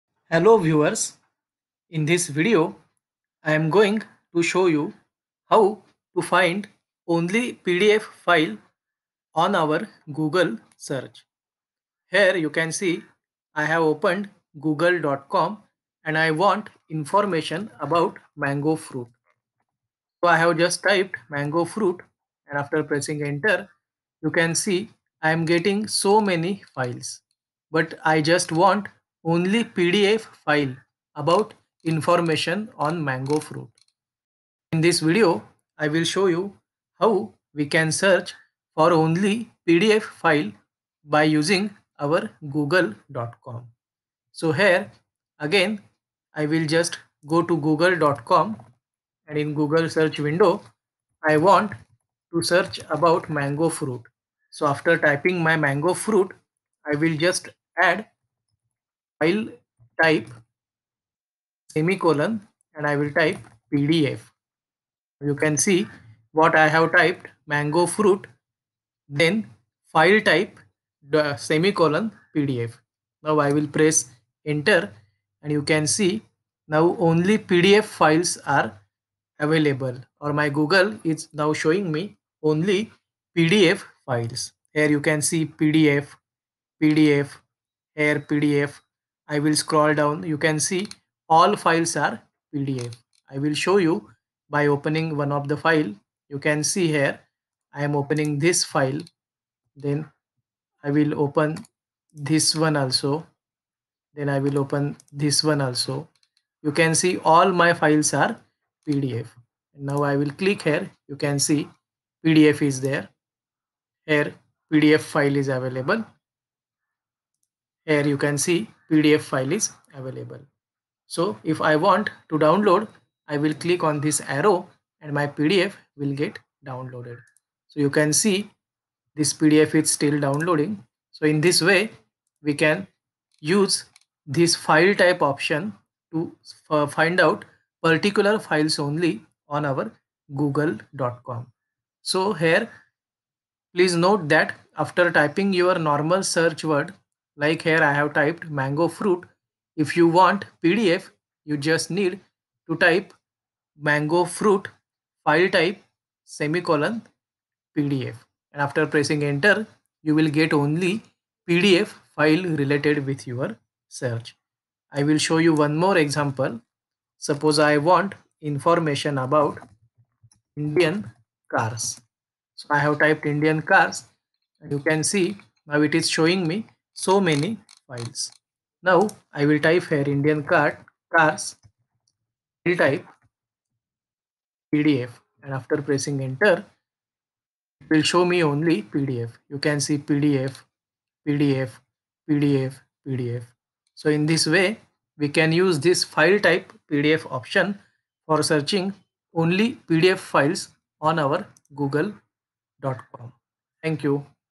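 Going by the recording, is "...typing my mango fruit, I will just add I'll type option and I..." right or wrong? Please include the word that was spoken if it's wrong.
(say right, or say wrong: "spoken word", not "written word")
wrong: "semicolon", not "option".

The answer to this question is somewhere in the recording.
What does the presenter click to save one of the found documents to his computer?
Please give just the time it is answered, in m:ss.
2:04.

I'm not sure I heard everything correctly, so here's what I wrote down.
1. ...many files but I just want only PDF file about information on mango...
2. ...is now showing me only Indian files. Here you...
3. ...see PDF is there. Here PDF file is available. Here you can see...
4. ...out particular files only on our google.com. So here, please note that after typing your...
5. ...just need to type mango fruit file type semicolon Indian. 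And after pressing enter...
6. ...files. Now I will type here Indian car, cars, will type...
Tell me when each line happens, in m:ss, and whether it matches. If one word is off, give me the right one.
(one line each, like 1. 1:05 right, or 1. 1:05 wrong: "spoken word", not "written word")
1. 0:26 right
2. 1:21 wrong: "PDF", not "Indian"
3. 1:51 right
4. 2:17 right
5. 2:31 wrong: "PDF", not "Indian"
6. 2:57 right.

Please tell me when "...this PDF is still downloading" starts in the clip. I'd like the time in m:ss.
2:09.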